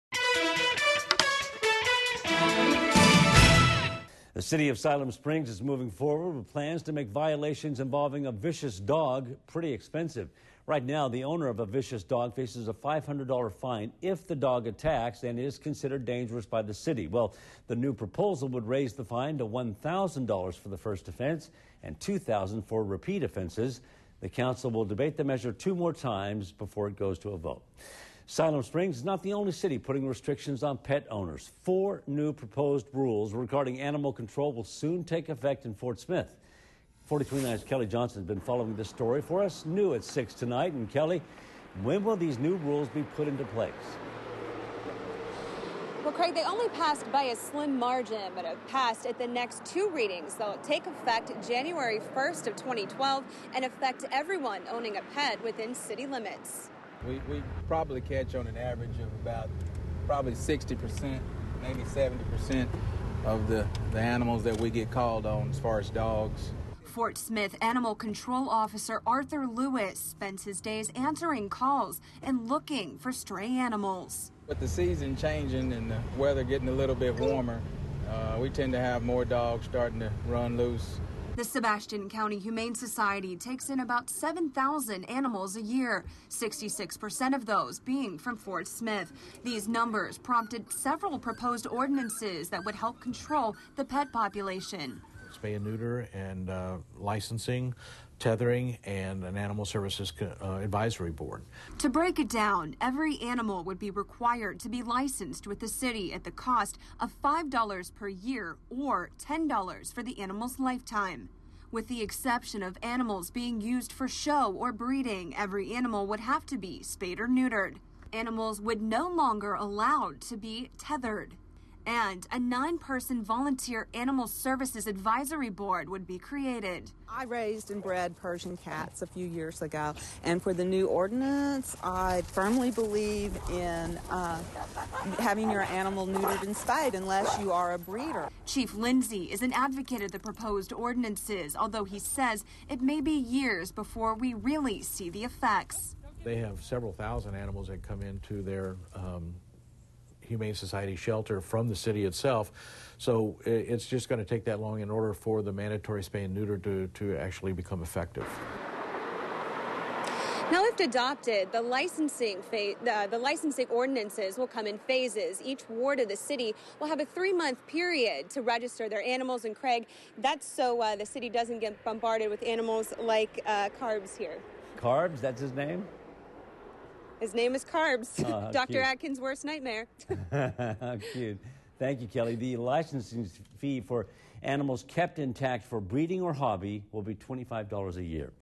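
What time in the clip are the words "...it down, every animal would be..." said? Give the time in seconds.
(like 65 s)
102 s.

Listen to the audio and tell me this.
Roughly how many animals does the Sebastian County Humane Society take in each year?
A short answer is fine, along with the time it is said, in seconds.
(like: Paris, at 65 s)
7,000, at 84 s.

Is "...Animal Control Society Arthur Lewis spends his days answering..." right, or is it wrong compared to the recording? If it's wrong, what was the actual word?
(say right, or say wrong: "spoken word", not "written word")
wrong: "Officer", not "Society".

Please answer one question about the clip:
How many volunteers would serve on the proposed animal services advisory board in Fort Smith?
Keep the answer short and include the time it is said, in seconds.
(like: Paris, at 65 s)
9, at 122 s.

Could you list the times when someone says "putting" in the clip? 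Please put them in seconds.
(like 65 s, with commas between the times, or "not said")
29 s.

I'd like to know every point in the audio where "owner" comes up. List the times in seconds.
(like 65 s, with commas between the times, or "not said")
11 s, 31 s.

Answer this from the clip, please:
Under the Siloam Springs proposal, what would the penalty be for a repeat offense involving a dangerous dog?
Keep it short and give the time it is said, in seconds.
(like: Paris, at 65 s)
$2,000, at 21 s.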